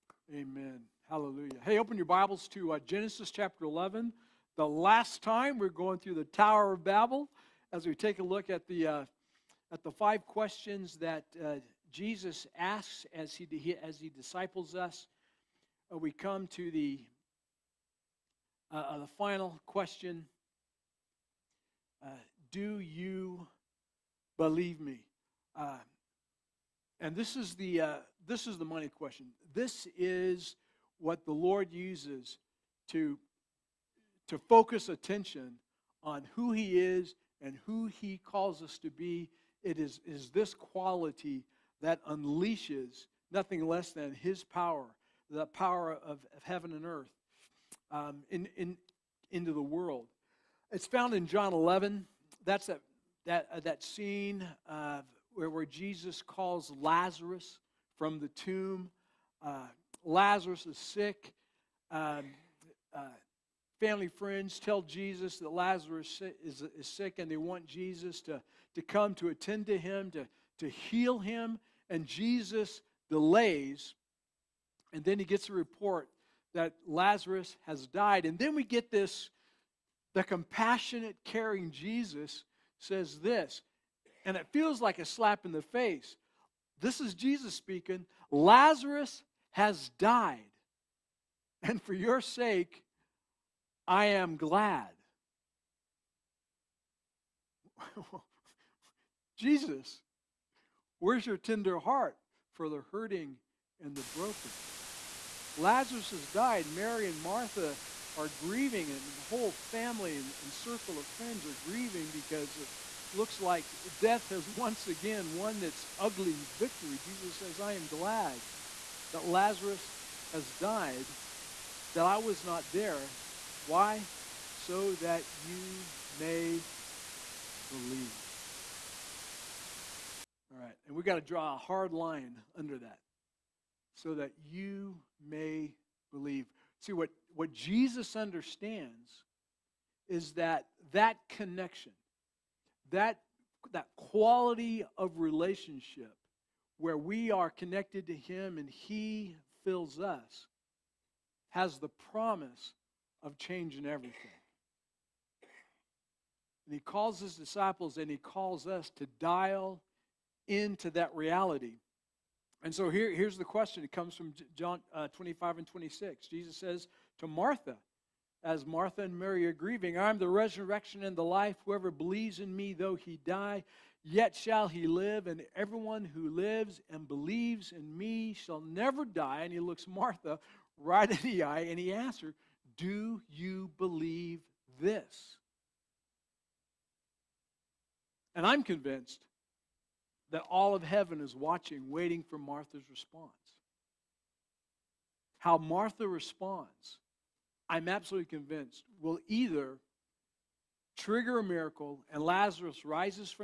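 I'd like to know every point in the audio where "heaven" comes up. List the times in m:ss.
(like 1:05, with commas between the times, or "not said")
0:46, 3:10.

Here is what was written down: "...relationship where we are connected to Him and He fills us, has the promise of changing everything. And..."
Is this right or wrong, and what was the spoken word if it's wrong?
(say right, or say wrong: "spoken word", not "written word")
right.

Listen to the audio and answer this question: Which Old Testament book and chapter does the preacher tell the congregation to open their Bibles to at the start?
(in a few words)
Genesis 11.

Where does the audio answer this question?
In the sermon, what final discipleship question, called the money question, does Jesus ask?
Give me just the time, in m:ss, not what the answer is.
0:22.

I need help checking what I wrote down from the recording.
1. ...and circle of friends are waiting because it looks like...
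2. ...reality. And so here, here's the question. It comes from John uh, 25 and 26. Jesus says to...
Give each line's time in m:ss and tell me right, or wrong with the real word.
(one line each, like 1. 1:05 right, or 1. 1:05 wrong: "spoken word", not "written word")
1. 1:50 wrong: "grieving", not "waiting"
2. 2:41 right.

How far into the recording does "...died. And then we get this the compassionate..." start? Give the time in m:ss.
1:17.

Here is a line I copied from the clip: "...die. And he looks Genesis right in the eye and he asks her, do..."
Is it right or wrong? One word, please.
wrong.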